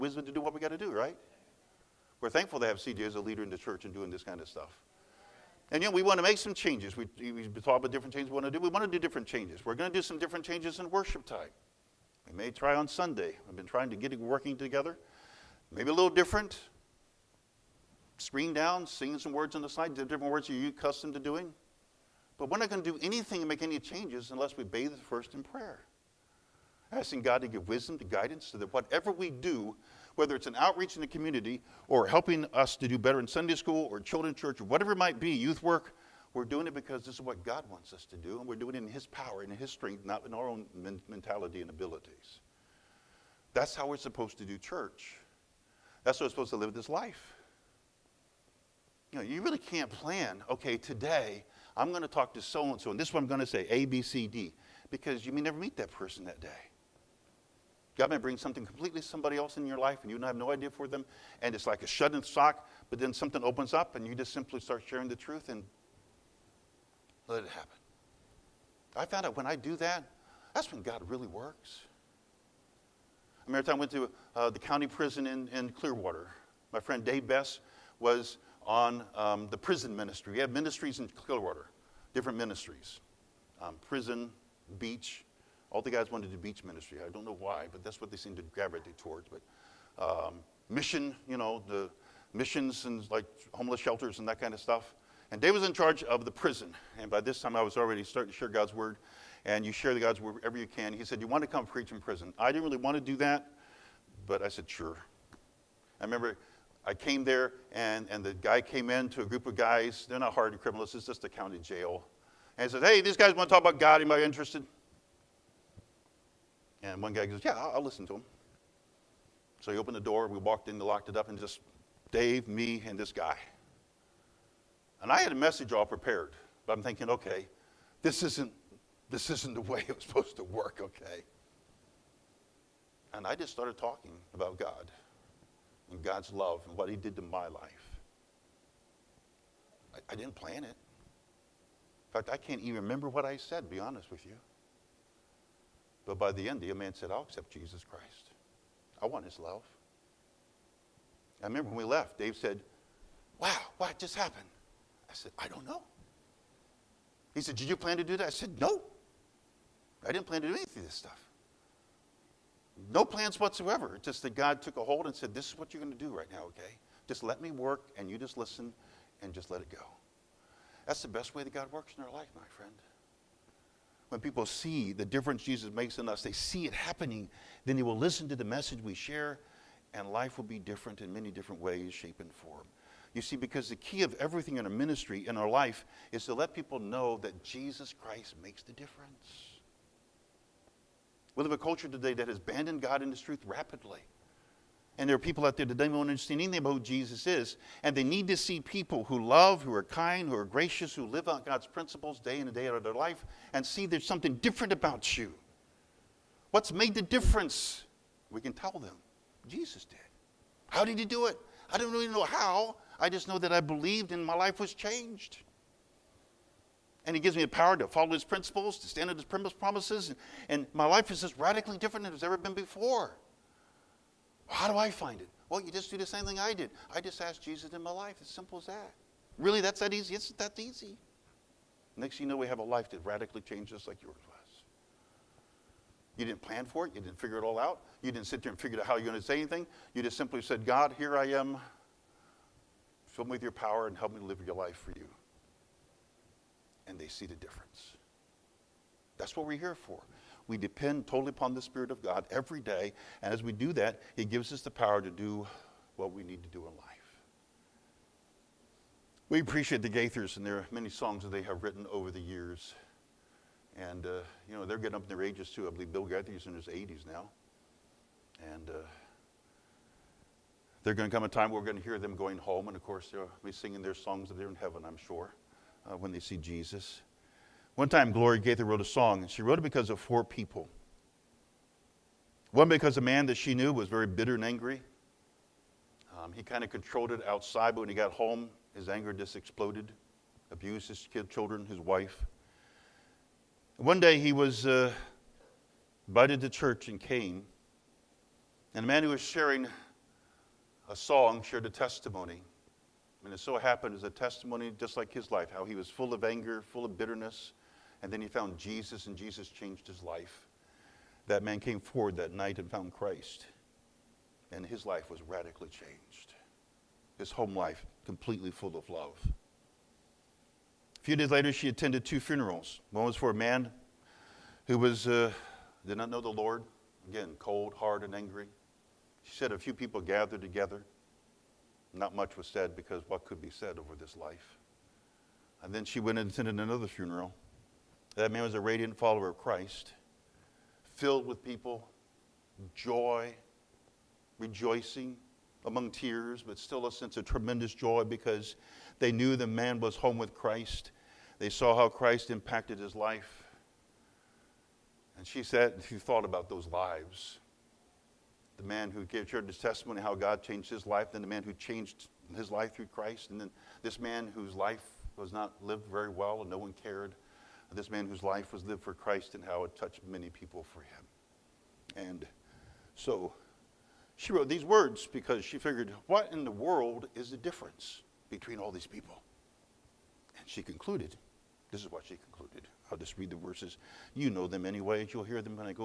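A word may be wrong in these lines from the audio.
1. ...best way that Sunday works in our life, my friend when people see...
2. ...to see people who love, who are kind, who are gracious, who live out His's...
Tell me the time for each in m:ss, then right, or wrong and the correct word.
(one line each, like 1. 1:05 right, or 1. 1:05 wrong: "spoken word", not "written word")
1. 2:51 wrong: "God", not "Sunday"
2. 3:18 wrong: "God", not "His".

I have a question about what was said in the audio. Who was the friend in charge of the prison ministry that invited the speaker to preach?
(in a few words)
Dave Bess.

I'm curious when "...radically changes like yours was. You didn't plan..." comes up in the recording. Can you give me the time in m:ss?
3:53.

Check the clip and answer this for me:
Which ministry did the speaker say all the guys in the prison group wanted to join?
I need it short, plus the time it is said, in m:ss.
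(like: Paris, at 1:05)
Beach ministry, at 1:26.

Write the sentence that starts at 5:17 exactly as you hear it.
His home life completely full of love.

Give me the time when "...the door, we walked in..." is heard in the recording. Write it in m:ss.
1:59.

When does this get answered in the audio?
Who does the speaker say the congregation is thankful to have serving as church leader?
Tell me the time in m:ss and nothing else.
0:02.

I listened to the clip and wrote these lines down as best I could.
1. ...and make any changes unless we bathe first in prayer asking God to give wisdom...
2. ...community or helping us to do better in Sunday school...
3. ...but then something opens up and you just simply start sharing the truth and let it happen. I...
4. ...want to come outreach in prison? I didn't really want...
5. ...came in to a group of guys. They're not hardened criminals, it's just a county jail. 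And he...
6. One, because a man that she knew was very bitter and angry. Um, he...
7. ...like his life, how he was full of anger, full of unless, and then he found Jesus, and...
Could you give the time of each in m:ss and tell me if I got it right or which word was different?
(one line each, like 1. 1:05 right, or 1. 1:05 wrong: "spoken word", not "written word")
1. 0:23 right
2. 0:31 right
3. 1:02 right
4. 1:41 wrong: "preach", not "outreach"
5. 1:48 right
6. 4:42 right
7. 5:04 wrong: "bitterness", not "unless".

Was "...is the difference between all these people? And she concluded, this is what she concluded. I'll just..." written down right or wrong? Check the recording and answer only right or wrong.
right.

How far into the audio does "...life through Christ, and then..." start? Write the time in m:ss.
6:02.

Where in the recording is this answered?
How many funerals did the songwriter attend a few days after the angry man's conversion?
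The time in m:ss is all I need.
5:22.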